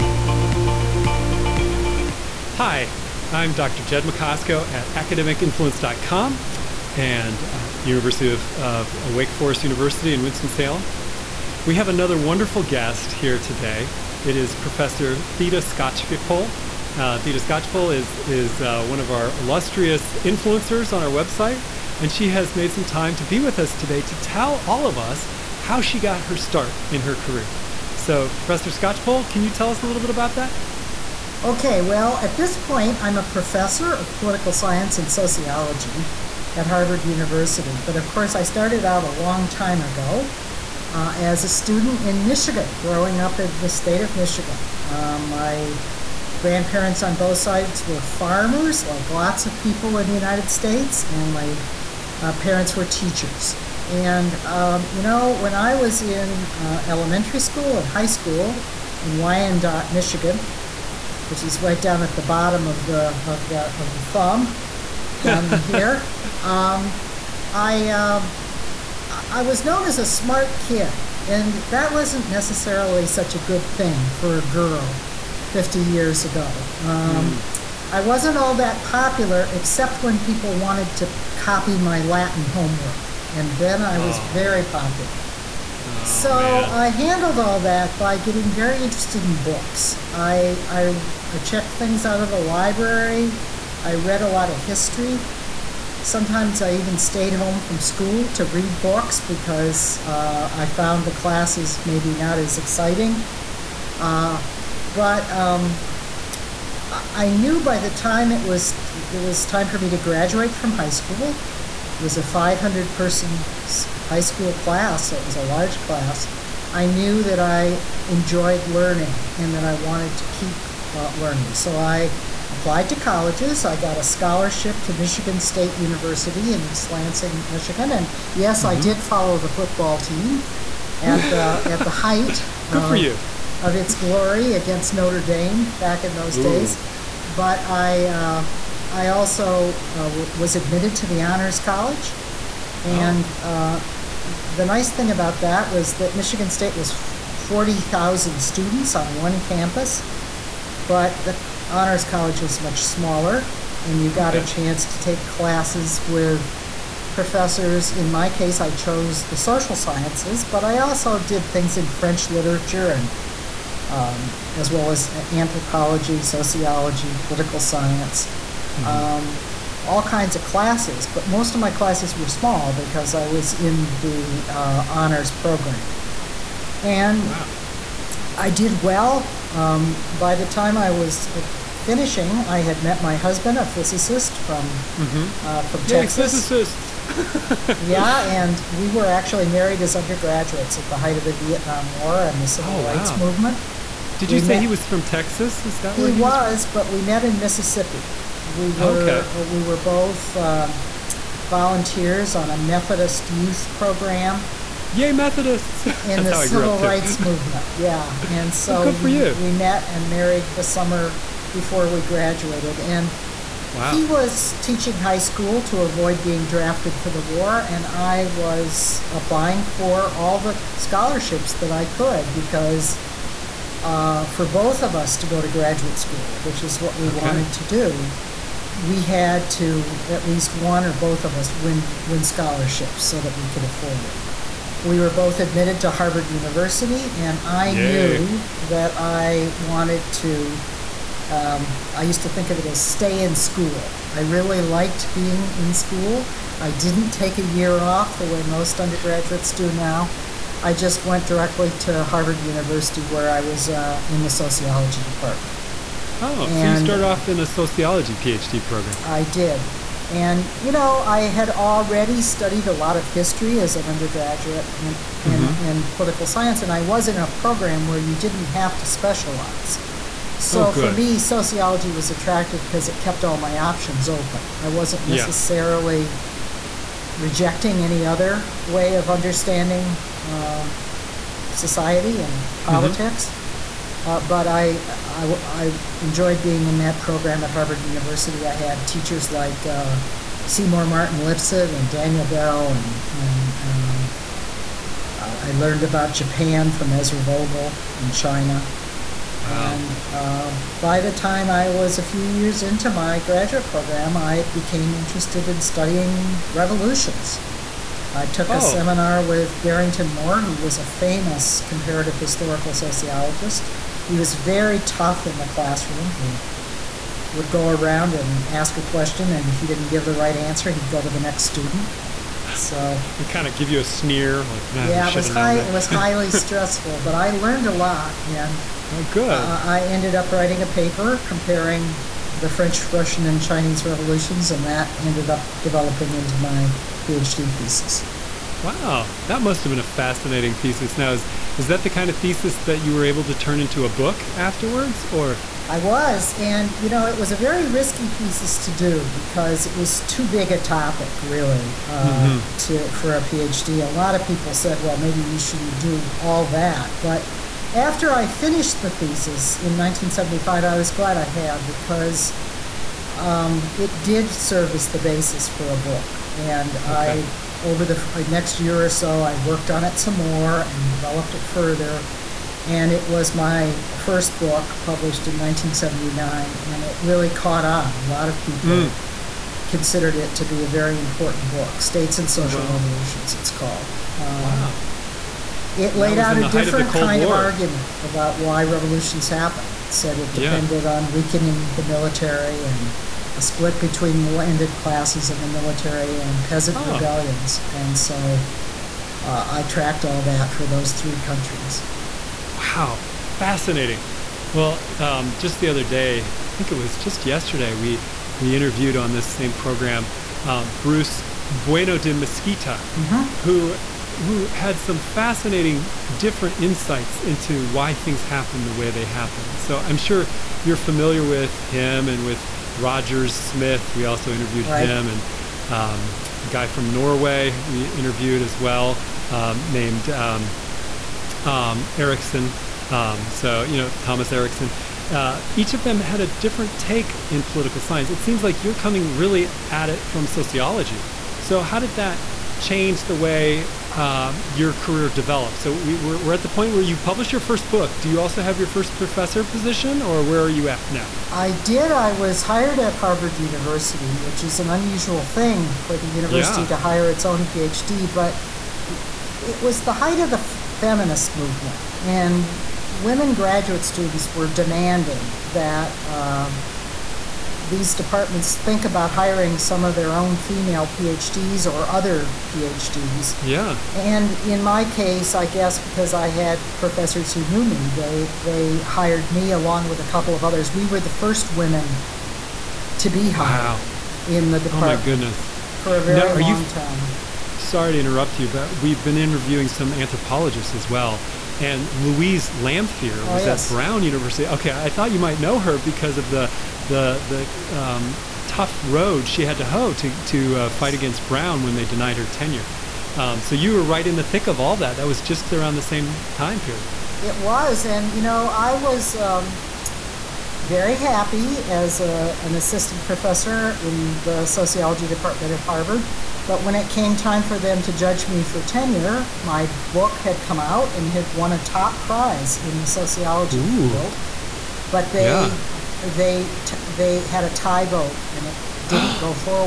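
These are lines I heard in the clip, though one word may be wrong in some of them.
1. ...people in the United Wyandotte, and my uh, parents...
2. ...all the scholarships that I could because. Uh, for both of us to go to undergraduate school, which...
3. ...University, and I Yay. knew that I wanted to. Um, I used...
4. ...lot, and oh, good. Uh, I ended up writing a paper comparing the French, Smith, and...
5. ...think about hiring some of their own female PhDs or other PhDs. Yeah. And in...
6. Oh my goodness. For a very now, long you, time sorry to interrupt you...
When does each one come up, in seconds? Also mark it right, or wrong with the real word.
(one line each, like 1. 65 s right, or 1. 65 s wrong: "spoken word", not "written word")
1. 49 s wrong: "States", not "Wyandotte"
2. 220 s wrong: "graduate", not "undergraduate"
3. 236 s right
4. 327 s wrong: "Russian", not "Smith"
5. 468 s right
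6. 484 s right.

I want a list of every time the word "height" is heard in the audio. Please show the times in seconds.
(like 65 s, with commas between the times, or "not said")
131 s, 190 s, 459 s.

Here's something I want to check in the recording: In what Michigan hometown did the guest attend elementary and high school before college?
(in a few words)
Wyandotte.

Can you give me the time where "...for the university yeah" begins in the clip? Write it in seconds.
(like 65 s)
455 s.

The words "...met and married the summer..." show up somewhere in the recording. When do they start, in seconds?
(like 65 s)
209 s.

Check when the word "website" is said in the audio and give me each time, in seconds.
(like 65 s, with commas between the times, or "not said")
21 s.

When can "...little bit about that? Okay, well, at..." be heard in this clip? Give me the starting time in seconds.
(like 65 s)
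29 s.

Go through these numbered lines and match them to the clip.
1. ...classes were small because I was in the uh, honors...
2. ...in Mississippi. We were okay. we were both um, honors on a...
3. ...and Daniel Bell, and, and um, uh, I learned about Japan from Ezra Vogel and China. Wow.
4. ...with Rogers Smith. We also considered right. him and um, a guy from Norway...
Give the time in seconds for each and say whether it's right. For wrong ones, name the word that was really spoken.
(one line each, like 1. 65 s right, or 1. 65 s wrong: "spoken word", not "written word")
1. 171 s right
2. 197 s wrong: "volunteers", not "honors"
3. 291 s right
4. 422 s wrong: "interviewed", not "considered".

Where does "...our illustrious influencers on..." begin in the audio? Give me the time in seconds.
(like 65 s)
19 s.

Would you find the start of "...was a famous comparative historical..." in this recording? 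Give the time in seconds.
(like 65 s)
310 s.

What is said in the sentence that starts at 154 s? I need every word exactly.
a chance to take classes with professors.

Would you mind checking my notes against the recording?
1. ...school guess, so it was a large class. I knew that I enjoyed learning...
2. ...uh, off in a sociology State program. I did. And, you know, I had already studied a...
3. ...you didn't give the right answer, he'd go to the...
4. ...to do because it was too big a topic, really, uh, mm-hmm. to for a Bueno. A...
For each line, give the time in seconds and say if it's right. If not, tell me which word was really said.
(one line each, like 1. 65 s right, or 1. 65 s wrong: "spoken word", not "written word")
1. 114 s wrong: "class", not "guess"
2. 257 s wrong: "PhD", not "State"
3. 319 s right
4. 348 s wrong: "PhD", not "Bueno".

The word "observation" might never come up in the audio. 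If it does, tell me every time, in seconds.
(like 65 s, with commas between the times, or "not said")
not said.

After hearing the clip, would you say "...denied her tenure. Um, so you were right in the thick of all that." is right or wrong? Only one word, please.
right.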